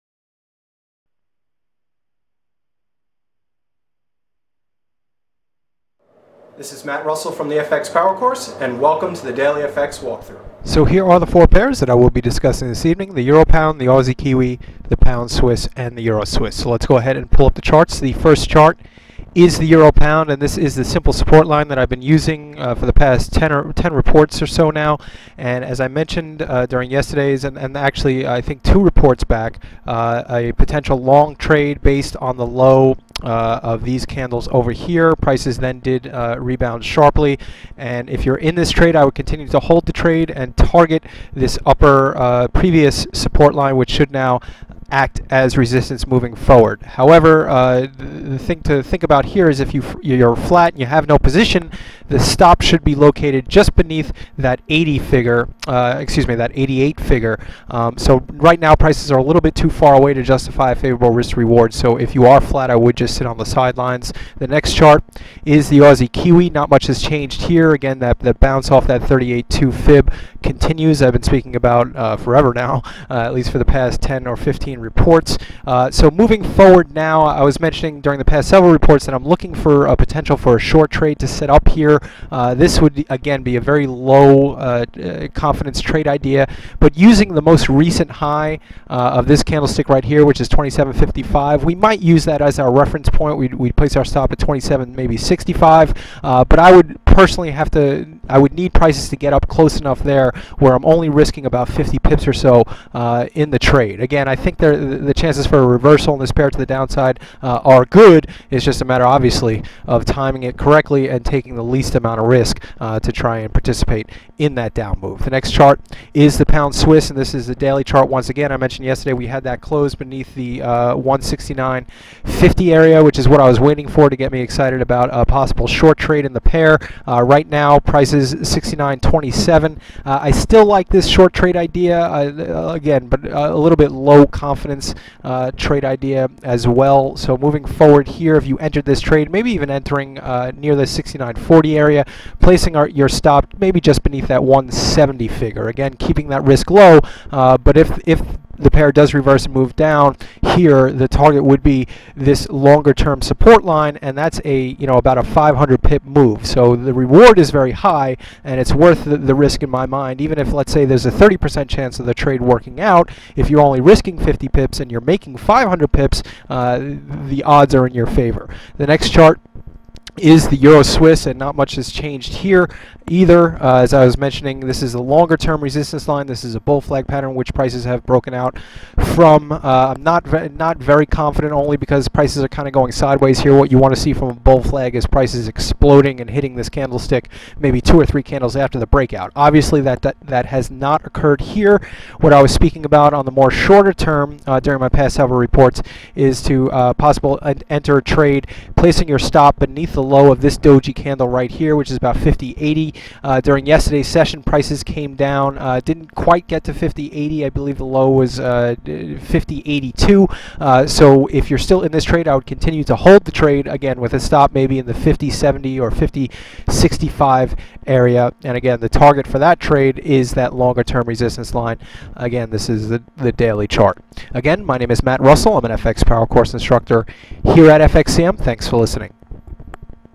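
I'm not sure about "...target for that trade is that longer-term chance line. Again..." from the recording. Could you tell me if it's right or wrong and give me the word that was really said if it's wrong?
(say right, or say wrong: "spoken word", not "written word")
wrong: "resistance", not "chance".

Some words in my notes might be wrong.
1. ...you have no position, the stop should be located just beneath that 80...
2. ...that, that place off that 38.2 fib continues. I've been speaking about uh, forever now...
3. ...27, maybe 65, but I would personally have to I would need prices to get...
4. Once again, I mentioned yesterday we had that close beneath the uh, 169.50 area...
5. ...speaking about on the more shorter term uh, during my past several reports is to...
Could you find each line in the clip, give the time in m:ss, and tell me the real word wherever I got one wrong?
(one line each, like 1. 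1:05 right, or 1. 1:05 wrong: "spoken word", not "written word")
1. 0:50 right
2. 1:07 wrong: "bounce", not "place"
3. 1:34 right
4. 1:58 right
5. 3:12 right.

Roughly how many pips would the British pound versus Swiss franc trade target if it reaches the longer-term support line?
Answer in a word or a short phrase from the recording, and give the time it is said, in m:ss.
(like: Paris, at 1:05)
500 pips, at 2:35.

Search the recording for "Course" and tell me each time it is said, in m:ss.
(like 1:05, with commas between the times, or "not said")
0:08, 3:46.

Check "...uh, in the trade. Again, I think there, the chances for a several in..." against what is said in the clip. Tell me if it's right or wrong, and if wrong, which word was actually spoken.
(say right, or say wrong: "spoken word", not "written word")
wrong: "reversal", not "several".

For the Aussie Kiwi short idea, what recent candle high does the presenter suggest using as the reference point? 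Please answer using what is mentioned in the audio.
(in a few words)
27.55.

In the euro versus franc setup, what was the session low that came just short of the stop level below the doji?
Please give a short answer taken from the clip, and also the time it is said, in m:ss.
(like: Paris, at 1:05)
50.82, at 3:28.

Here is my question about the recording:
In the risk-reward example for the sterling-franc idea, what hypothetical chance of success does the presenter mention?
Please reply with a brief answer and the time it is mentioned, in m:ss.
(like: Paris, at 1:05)
30%, at 2:41.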